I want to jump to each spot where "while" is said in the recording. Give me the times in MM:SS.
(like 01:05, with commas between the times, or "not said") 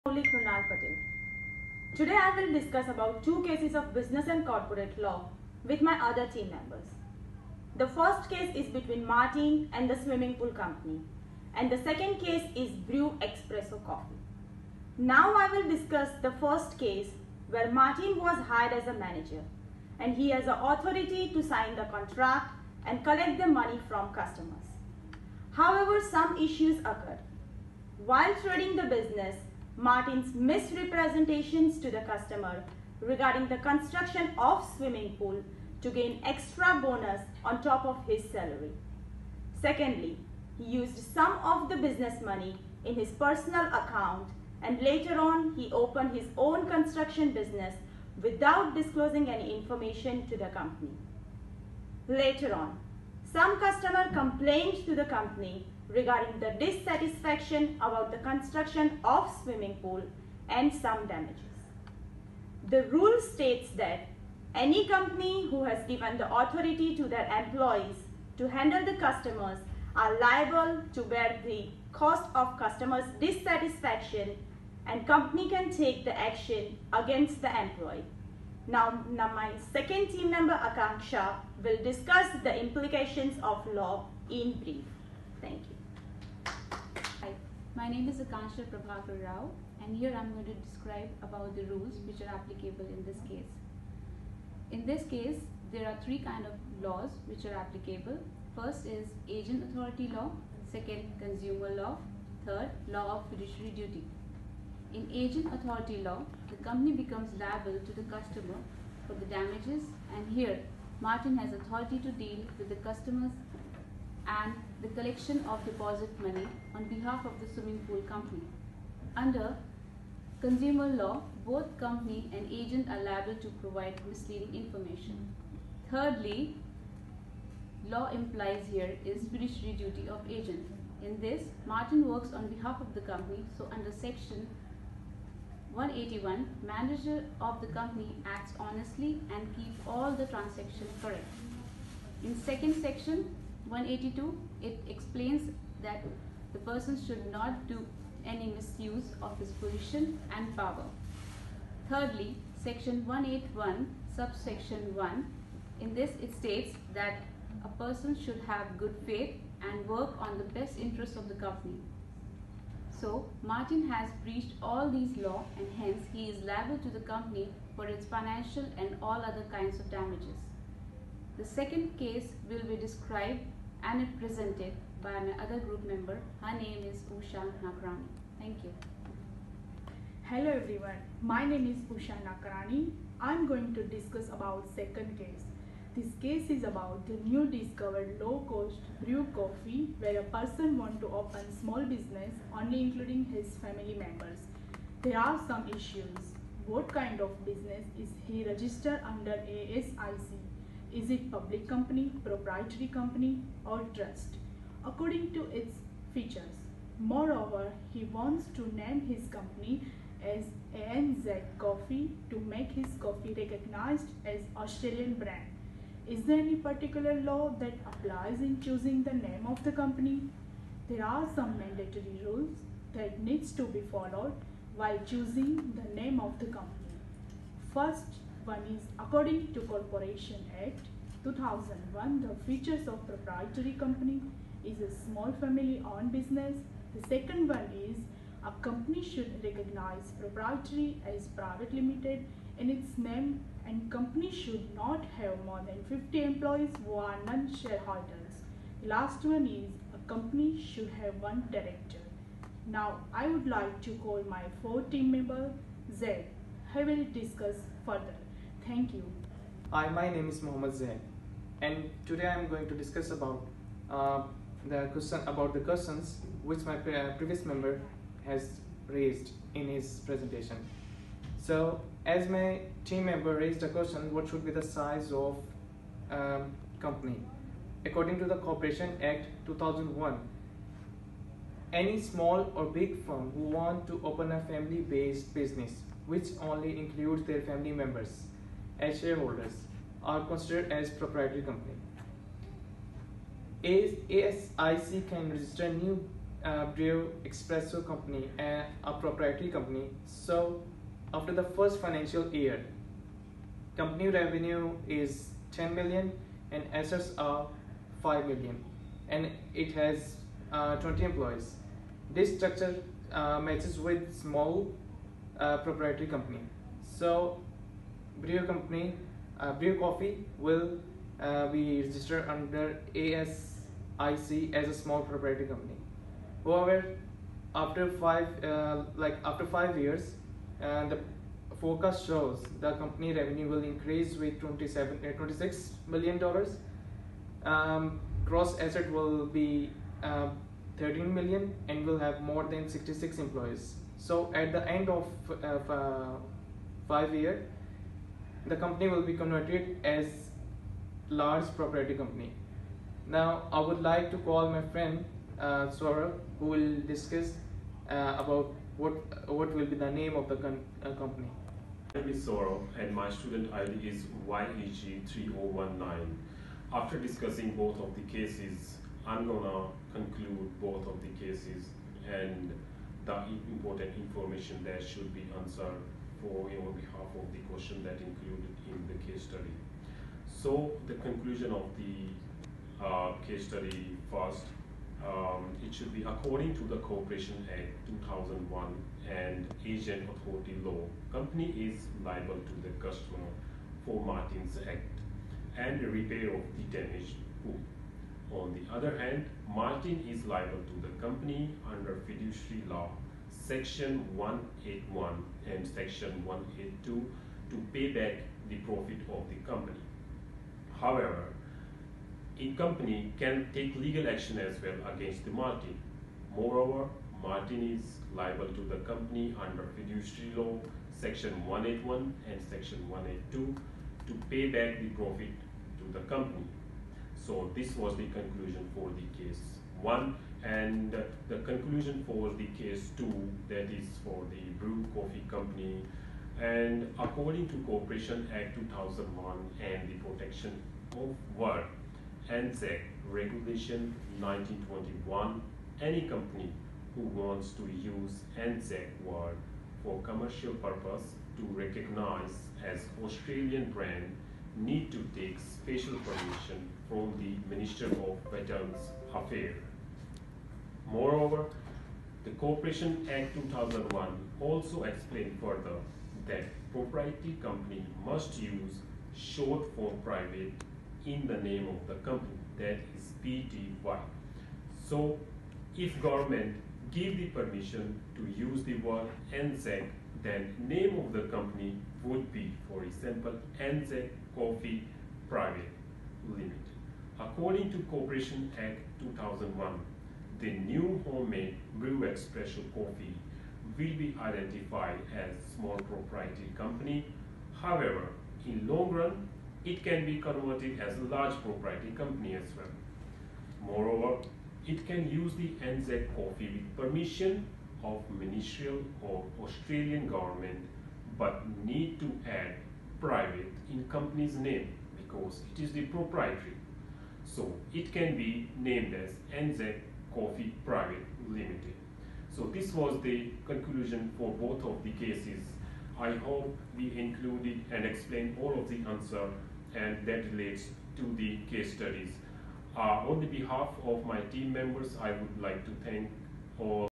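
00:28, 03:44.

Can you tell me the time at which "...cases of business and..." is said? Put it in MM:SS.
00:03.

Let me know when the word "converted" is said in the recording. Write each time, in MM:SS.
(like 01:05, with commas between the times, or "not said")
05:49, 08:20.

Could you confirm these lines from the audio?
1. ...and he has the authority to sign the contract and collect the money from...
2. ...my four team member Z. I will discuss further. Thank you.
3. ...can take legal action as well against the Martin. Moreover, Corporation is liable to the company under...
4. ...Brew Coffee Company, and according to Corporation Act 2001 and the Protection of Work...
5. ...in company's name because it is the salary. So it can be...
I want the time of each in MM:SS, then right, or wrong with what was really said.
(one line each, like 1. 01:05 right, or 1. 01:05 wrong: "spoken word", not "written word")
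1. 00:19 right
2. 04:14 right
3. 06:53 wrong: "Martin", not "Corporation"
4. 07:14 right
5. 08:33 wrong: "proprietary", not "salary".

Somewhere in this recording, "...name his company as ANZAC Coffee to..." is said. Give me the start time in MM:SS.
03:28.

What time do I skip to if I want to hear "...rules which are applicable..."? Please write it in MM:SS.
01:31.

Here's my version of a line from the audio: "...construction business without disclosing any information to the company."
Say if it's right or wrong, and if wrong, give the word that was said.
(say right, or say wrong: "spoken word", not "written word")
right.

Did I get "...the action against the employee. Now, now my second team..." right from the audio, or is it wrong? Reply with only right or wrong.
right.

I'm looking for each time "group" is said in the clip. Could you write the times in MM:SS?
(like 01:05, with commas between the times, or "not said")
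02:55.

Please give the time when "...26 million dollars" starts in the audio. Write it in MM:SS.
05:35.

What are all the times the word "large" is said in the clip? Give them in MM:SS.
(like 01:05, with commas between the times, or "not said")
05:51, 08:21.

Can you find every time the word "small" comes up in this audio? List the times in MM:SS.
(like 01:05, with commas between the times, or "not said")
03:11, 03:55, 04:41, 05:14, 05:24, 08:15.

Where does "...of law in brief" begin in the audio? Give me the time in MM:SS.
01:23.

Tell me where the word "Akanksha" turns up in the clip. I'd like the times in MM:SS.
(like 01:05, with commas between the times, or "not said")
01:20, 01:28.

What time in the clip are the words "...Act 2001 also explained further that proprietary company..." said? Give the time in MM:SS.
07:43.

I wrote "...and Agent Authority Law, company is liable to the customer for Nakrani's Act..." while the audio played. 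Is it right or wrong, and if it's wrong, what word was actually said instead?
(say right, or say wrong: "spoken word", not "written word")
wrong: "Martin", not "Nakrani".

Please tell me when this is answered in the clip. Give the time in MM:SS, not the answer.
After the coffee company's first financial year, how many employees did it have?
05:10.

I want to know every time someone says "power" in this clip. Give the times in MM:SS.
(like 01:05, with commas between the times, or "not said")
02:30.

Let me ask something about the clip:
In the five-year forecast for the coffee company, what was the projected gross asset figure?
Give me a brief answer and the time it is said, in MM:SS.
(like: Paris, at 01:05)
13 million, at 05:40.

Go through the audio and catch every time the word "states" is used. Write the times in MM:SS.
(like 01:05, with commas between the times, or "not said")
01:03, 02:36.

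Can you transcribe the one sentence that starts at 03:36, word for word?
Is there any particular law that applies in choosing the name of the company?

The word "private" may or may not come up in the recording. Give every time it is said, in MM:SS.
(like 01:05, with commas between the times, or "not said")
04:01, 07:50, 08:05, 08:32, 08:40.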